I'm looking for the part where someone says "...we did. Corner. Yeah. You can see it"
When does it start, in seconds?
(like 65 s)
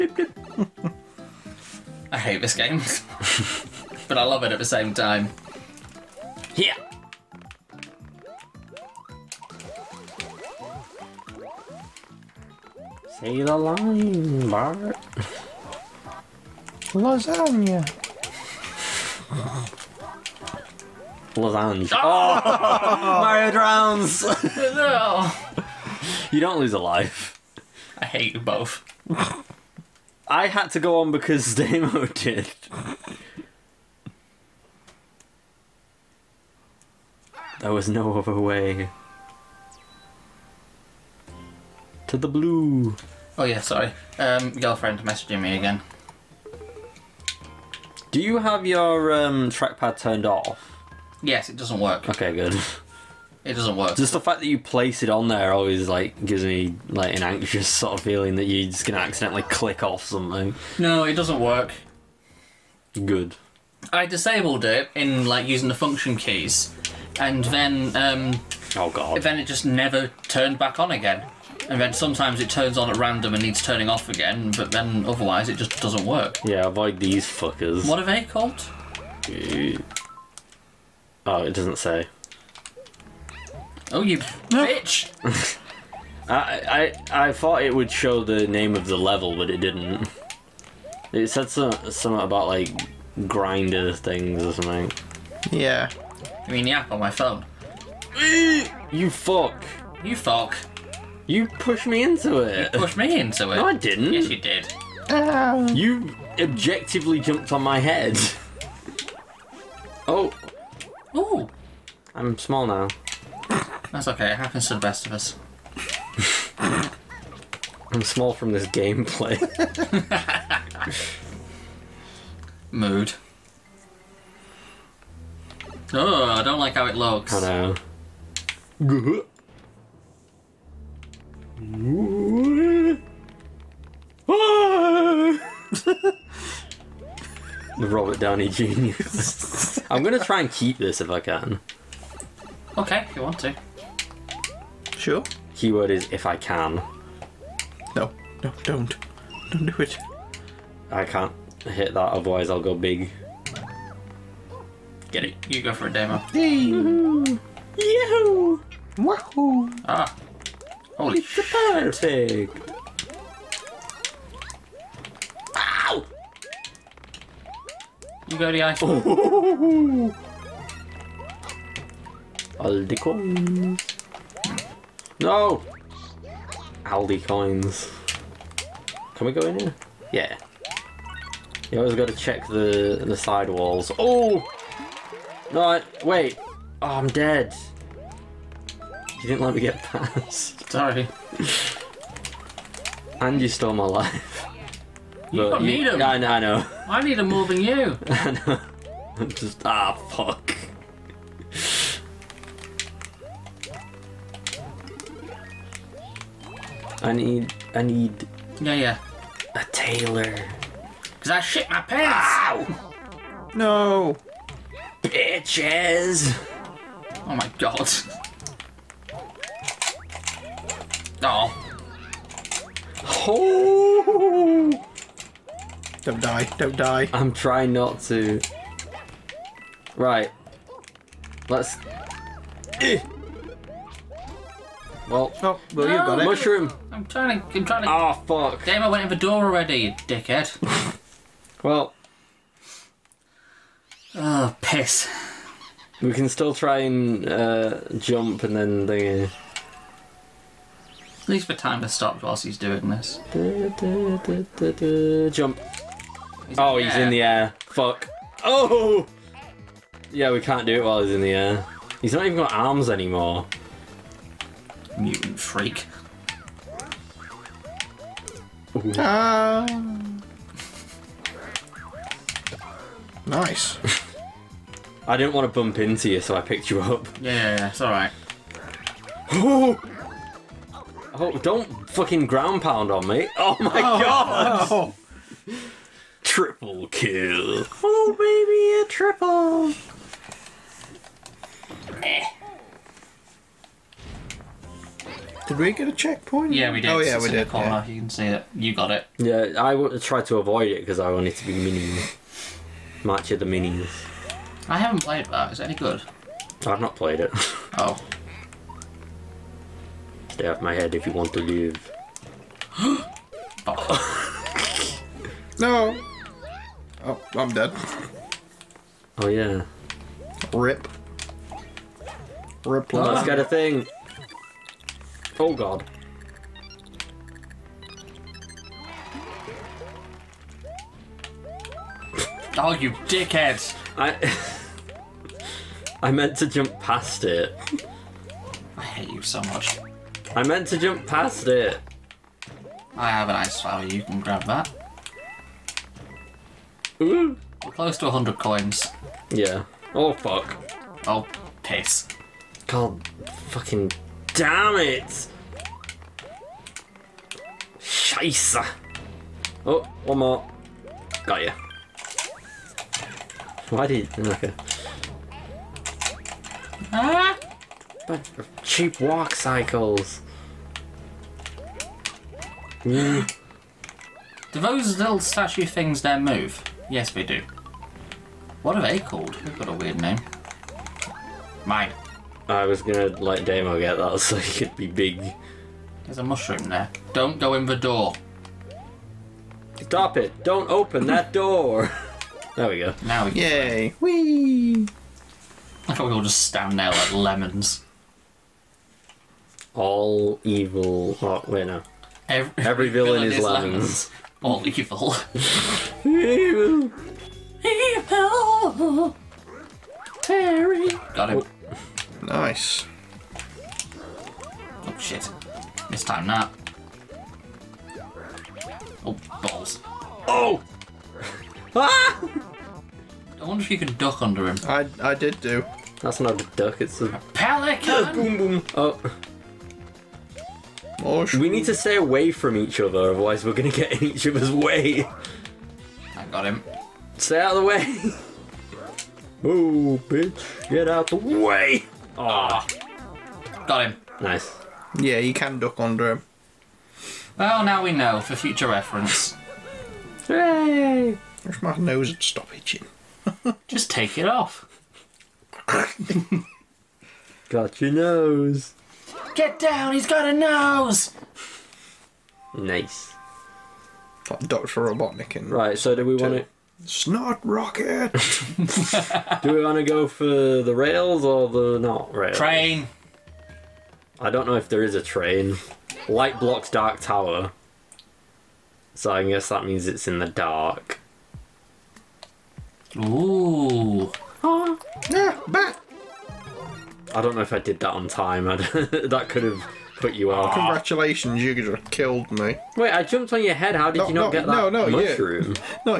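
297 s.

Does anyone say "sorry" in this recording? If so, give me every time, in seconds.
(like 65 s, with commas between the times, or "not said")
43 s, 190 s.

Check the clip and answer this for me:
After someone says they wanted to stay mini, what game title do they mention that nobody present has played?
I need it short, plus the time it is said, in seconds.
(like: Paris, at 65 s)
March of the Minis, at 303 s.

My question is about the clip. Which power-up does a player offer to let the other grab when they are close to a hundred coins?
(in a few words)
ice flower.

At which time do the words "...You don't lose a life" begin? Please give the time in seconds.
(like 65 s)
26 s.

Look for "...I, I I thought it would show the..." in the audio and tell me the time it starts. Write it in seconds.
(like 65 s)
86 s.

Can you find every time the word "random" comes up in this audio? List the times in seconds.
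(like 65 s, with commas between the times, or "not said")
72 s.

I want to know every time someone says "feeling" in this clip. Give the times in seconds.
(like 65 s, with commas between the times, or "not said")
57 s.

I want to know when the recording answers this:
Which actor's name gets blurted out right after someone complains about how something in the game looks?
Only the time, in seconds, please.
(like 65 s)
137 s.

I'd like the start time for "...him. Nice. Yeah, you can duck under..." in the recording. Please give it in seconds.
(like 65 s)
443 s.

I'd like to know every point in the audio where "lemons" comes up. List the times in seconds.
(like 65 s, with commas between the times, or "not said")
397 s, 403 s.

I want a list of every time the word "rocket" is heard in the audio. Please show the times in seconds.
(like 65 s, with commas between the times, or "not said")
467 s.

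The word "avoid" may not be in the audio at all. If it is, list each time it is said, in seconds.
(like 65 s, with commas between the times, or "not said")
76 s, 300 s.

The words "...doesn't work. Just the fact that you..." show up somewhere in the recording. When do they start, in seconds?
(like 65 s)
53 s.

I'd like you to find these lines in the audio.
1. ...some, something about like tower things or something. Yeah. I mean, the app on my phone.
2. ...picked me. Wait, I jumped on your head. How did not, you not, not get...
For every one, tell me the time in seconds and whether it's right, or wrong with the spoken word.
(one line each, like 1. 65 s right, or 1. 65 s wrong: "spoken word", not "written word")
1. 91 s wrong: "grinder", not "tower"
2. 491 s wrong: "killed", not "picked".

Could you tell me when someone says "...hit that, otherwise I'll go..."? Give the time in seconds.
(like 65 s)
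151 s.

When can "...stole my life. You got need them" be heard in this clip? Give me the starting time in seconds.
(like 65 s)
193 s.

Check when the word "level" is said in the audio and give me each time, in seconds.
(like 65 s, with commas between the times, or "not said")
88 s.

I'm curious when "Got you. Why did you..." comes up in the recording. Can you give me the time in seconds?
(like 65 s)
361 s.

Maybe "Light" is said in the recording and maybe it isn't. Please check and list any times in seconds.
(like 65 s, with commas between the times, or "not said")
476 s.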